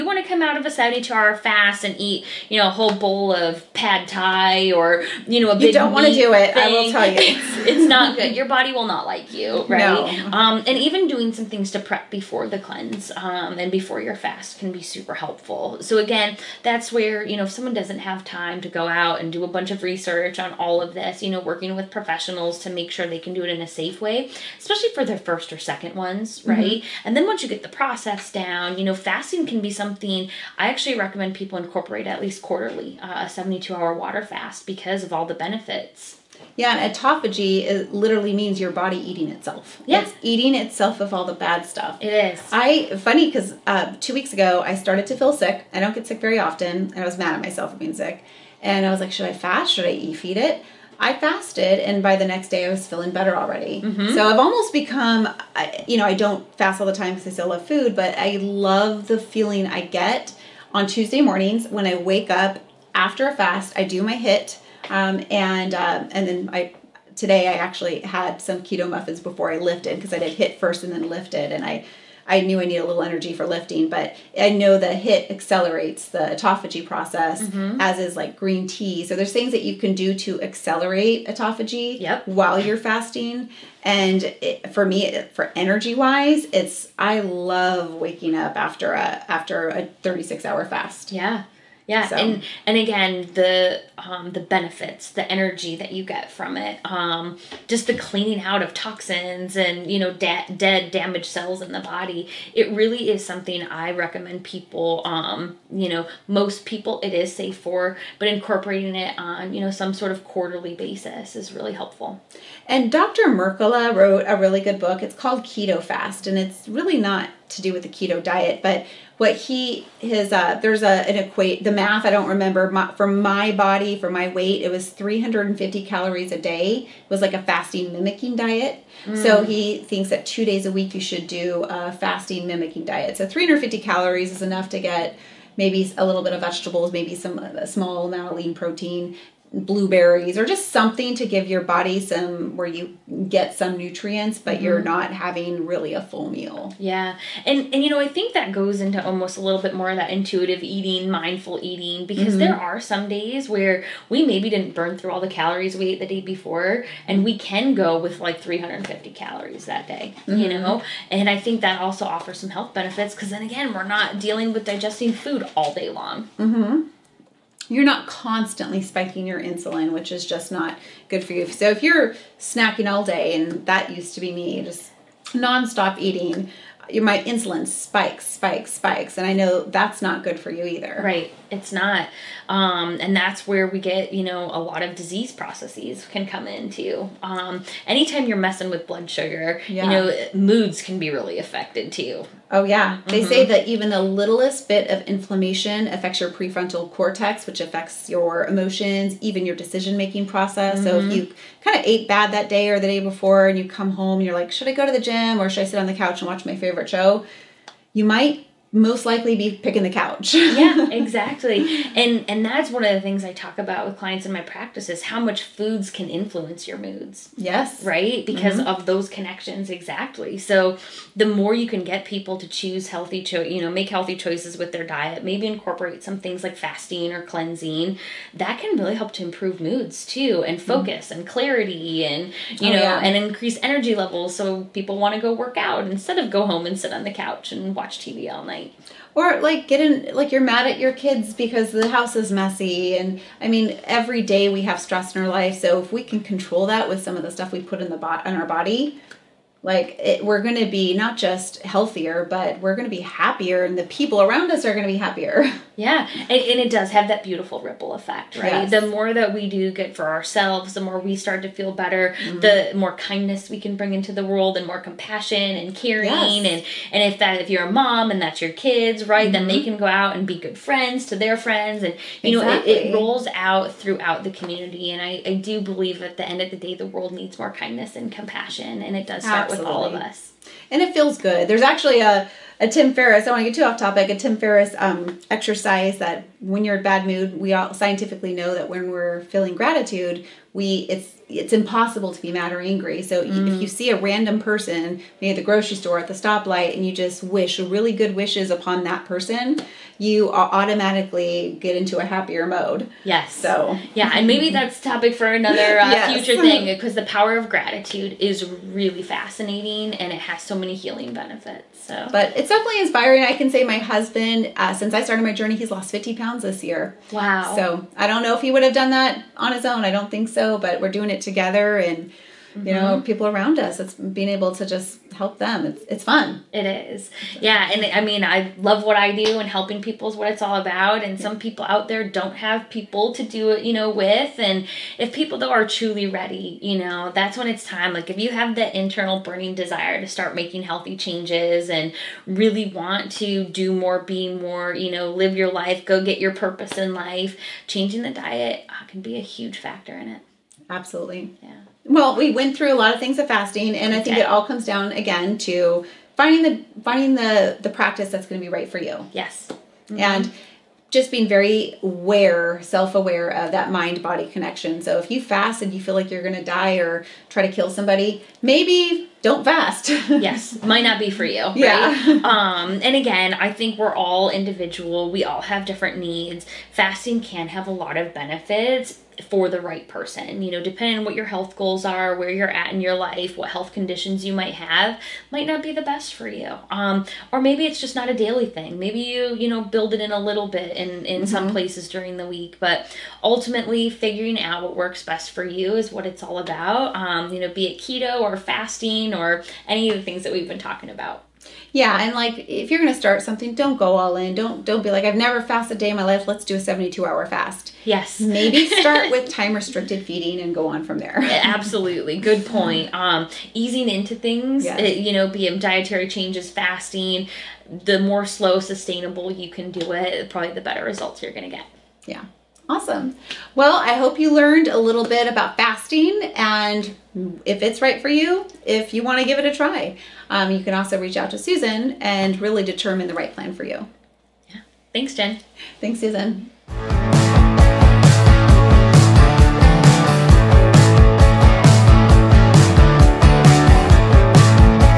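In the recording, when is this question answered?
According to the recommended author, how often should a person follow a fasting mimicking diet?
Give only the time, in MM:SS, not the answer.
02:10.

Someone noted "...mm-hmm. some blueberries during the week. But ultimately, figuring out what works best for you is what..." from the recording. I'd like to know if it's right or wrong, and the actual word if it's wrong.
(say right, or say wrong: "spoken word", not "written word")
wrong: "places", not "blueberries".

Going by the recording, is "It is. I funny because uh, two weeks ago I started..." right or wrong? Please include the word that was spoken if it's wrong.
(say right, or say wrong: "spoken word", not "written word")
right.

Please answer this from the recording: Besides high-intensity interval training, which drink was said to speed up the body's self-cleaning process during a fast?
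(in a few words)
Green tea.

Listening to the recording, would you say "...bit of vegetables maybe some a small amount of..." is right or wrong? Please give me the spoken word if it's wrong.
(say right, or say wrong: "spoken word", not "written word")
right.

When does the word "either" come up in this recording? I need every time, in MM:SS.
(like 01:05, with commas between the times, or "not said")
03:00.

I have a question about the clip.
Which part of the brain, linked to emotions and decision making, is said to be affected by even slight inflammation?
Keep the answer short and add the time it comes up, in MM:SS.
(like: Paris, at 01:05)
Prefrontal cortex, at 03:16.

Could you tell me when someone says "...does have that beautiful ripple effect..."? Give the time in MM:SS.
04:16.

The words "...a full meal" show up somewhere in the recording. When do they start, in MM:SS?
02:25.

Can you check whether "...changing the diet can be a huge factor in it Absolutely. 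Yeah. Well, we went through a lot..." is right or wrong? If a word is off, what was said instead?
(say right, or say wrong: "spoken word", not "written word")
right.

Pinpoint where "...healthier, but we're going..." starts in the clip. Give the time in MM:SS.
04:11.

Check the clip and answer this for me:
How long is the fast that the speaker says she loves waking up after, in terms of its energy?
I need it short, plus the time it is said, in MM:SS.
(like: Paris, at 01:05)
36 hours, at 01:30.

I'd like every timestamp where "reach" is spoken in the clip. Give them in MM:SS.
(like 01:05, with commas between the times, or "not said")
07:11.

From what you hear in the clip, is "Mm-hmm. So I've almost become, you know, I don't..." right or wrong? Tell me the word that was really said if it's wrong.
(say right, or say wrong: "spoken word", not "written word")
right.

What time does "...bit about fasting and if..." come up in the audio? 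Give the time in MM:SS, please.
07:05.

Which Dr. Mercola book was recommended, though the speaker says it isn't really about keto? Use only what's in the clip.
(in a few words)
Keto Fast.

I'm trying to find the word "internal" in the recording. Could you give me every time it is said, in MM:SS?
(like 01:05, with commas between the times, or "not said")
05:38.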